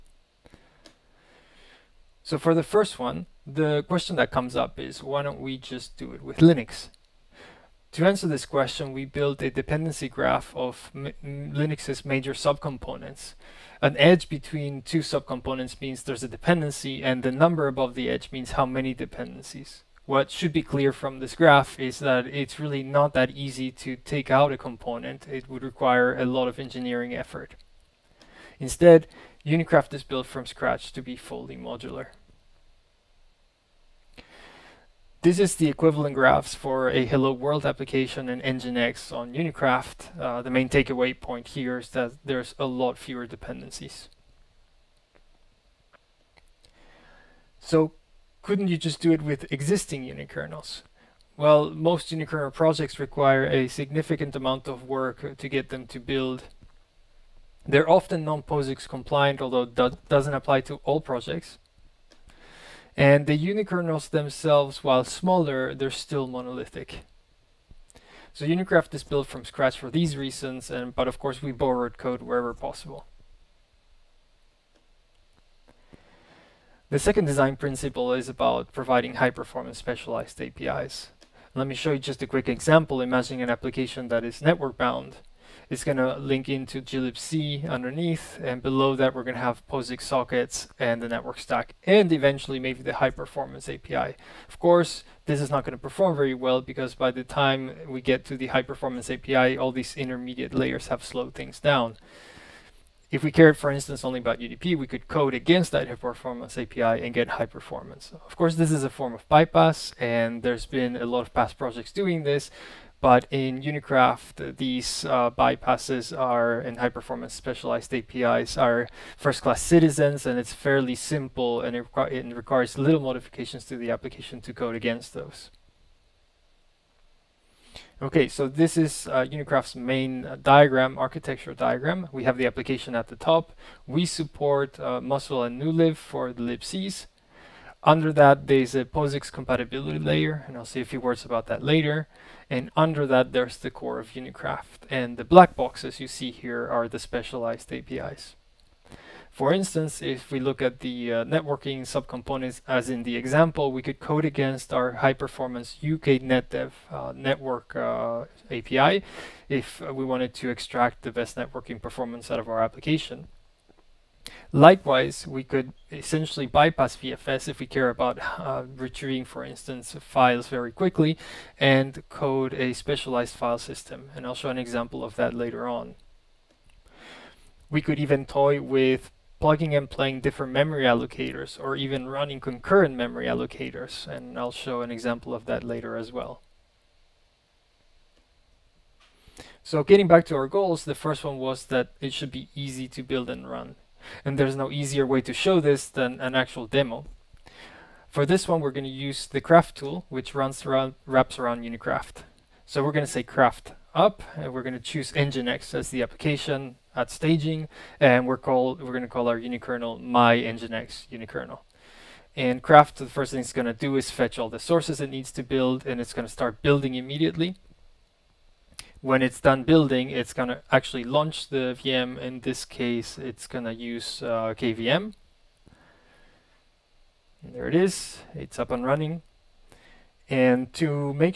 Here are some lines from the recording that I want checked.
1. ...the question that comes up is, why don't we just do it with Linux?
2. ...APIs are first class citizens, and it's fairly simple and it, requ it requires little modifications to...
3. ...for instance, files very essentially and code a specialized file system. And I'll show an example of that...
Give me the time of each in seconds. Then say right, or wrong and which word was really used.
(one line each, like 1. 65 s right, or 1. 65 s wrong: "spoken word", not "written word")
1. 3 s right
2. 117 s right
3. 169 s wrong: "quickly", not "essentially".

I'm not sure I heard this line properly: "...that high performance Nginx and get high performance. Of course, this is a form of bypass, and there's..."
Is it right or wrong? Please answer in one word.
wrong.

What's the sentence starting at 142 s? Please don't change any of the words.
And under that, there's the core of Unikraft.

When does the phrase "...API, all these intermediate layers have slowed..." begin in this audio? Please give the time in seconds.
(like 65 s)
99 s.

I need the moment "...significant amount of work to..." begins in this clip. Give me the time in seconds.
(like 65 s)
53 s.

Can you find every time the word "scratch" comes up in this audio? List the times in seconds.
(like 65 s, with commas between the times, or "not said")
30 s, 69 s.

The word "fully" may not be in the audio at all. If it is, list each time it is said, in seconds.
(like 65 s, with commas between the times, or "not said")
31 s.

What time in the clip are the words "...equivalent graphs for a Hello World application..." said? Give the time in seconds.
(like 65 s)
35 s.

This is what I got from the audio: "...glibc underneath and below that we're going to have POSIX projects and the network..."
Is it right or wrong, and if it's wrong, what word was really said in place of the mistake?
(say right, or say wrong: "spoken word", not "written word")
wrong: "sockets", not "projects".